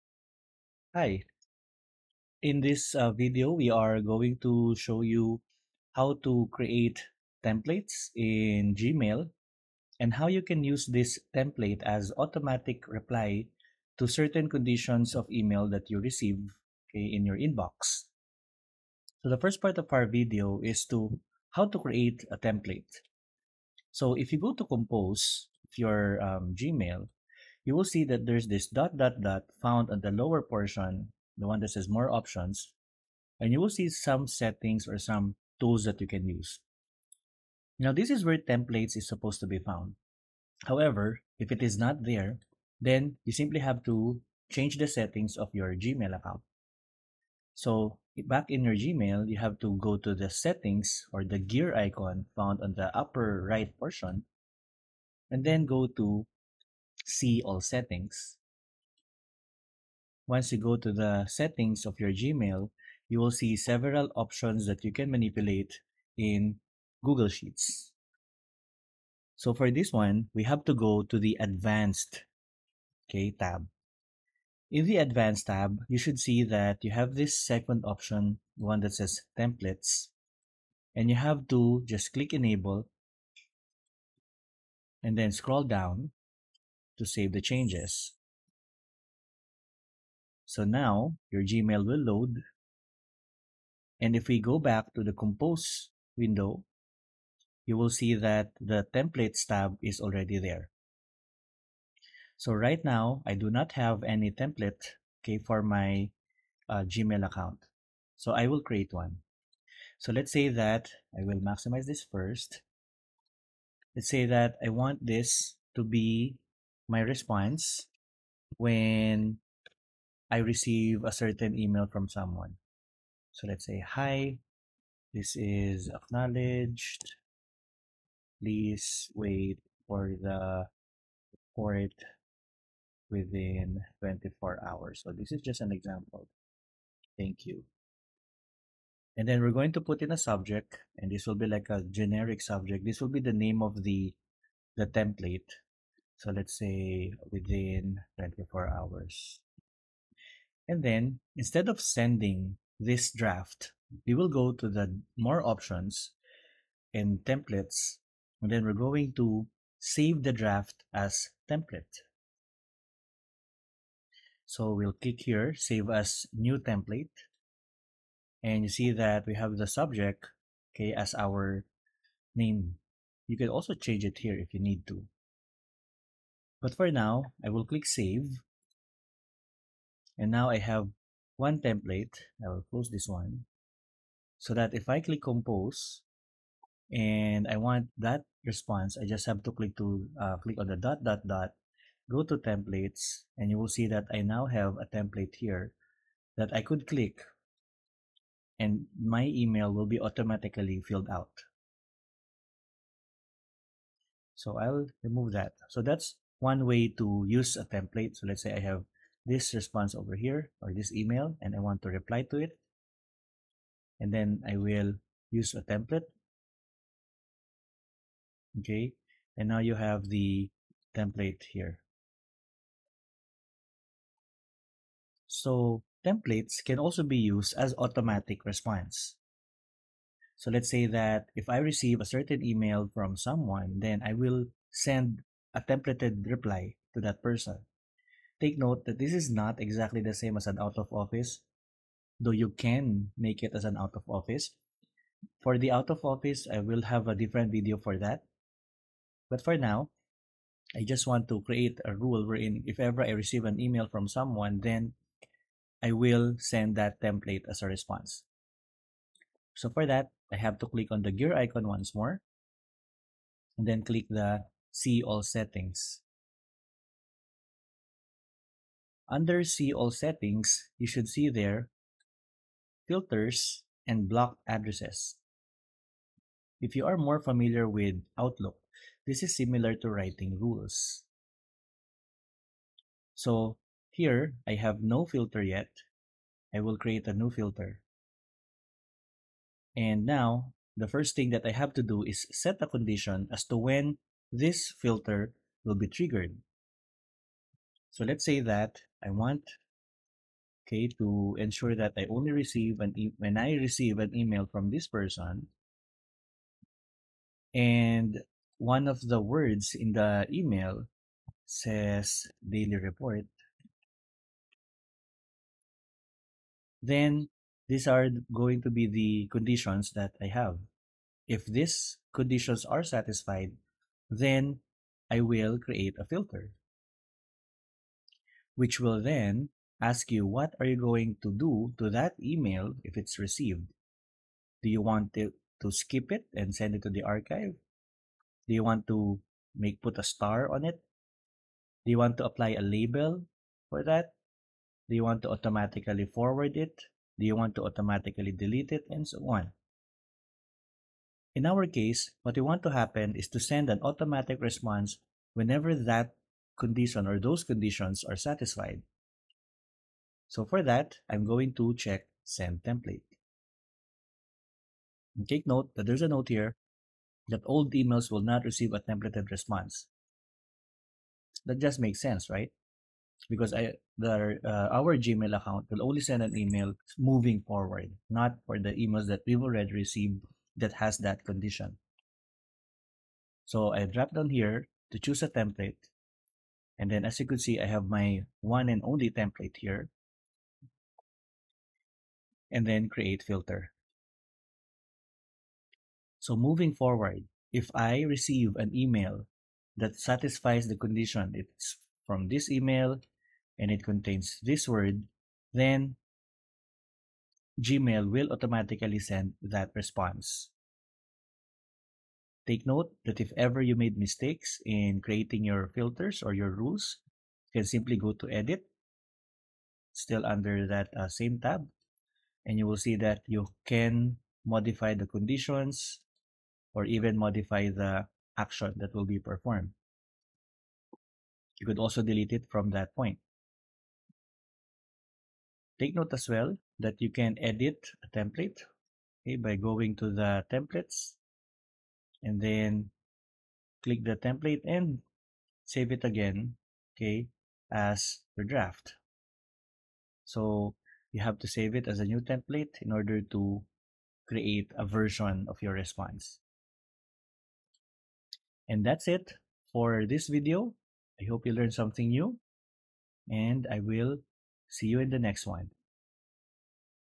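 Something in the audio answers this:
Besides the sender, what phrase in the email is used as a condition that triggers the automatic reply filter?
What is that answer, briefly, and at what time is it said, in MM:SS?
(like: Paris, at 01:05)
daily report, at 05:12.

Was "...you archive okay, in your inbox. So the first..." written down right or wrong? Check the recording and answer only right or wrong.
wrong.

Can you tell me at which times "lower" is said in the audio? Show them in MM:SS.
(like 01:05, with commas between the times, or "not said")
00:30.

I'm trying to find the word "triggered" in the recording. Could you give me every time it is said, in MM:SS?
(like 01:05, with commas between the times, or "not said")
04:55.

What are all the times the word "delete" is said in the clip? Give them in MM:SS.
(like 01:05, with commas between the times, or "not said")
05:48, 07:12.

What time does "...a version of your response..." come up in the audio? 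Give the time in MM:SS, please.
07:34.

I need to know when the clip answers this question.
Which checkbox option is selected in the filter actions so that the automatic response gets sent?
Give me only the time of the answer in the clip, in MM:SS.
06:02.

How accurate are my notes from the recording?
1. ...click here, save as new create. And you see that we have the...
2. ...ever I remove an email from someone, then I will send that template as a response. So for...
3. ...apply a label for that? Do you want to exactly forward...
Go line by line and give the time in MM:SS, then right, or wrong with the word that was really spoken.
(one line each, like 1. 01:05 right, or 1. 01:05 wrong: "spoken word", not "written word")
1. 02:45 wrong: "template", not "create"
2. 04:12 wrong: "receive", not "remove"
3. 05:42 wrong: "automatically", not "exactly".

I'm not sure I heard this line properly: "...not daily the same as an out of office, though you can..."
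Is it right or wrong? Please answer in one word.
wrong.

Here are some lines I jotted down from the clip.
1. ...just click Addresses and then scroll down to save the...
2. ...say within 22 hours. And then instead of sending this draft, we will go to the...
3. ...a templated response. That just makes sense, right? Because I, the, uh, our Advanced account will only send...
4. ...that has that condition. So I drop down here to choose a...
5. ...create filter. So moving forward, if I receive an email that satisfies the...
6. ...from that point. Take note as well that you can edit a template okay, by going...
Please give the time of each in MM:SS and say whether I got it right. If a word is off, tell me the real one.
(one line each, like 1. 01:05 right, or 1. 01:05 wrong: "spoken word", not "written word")
1. 01:21 wrong: "Enable", not "Addresses"
2. 02:26 wrong: "24", not "22"
3. 06:08 wrong: "Gmail", not "Advanced"
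4. 06:20 right
5. 06:32 right
6. 07:12 right.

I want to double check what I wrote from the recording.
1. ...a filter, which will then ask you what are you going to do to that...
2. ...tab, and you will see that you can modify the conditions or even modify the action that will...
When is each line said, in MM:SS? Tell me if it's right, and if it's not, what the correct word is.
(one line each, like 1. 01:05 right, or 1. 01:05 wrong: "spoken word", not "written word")
1. 05:25 right
2. 07:01 right.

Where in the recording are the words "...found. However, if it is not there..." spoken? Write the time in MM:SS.
00:39.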